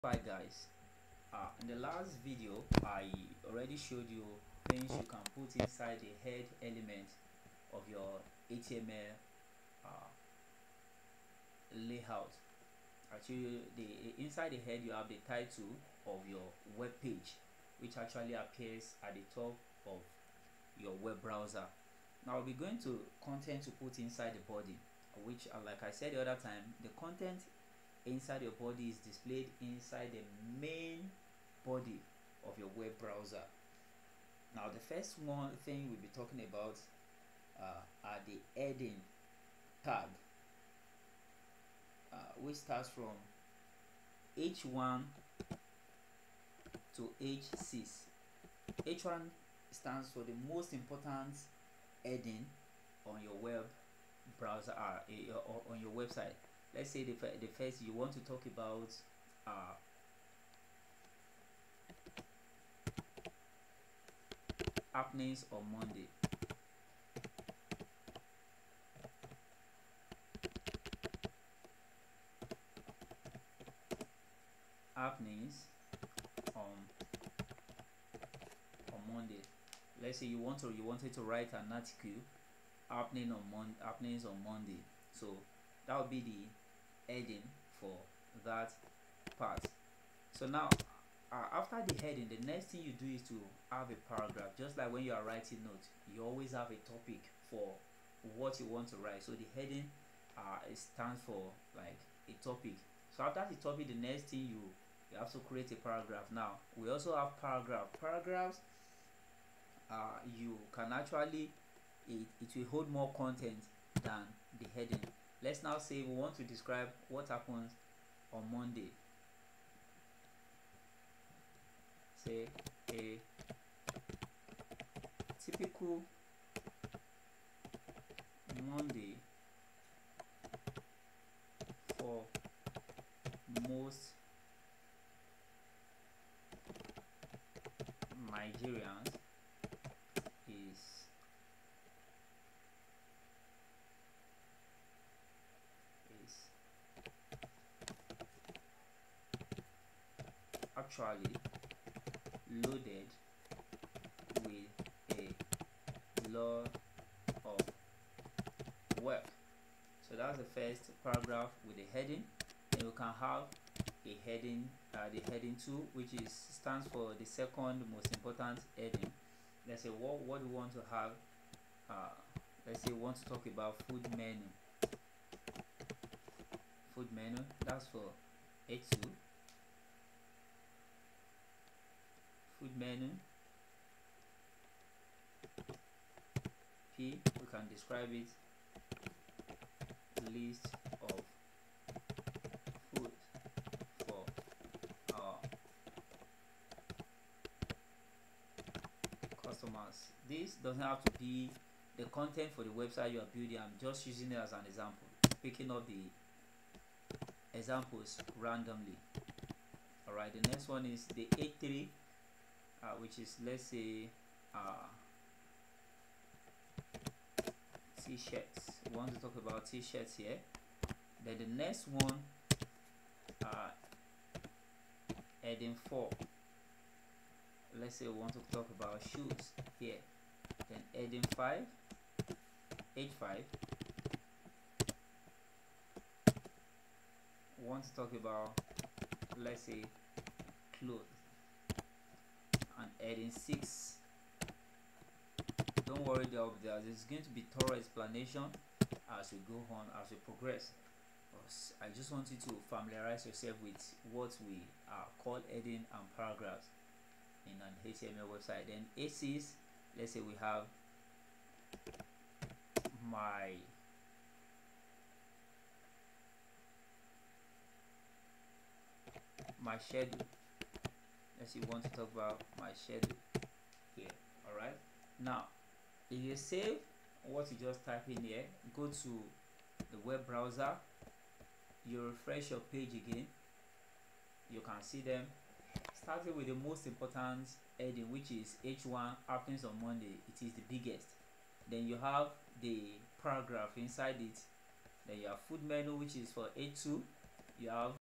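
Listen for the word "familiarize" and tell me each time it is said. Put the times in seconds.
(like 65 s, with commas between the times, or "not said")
252 s.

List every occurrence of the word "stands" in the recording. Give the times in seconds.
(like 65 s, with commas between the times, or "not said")
49 s, 100 s, 166 s.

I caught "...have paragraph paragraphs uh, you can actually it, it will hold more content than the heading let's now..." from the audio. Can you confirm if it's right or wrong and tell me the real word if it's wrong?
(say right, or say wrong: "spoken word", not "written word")
right.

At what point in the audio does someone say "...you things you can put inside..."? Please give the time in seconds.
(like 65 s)
4 s.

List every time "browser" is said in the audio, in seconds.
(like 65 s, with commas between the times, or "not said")
21 s, 32 s, 54 s, 280 s.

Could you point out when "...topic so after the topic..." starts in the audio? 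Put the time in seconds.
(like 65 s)
102 s.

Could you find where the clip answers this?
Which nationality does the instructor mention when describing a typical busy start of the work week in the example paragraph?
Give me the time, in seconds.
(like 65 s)
138 s.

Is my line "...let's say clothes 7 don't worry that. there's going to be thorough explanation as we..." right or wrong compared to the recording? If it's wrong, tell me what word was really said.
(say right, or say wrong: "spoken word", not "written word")
wrong: "6", not "7".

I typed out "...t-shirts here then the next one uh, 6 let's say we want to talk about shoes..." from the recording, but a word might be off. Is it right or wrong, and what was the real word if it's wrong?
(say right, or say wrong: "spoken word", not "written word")
wrong: "4", not "6".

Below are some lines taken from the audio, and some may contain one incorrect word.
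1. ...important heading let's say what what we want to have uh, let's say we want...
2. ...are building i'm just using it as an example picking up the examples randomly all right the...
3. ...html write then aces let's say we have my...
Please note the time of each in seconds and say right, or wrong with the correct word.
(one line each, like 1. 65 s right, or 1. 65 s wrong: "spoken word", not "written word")
1. 168 s right
2. 203 s right
3. 257 s wrong: "website", not "write".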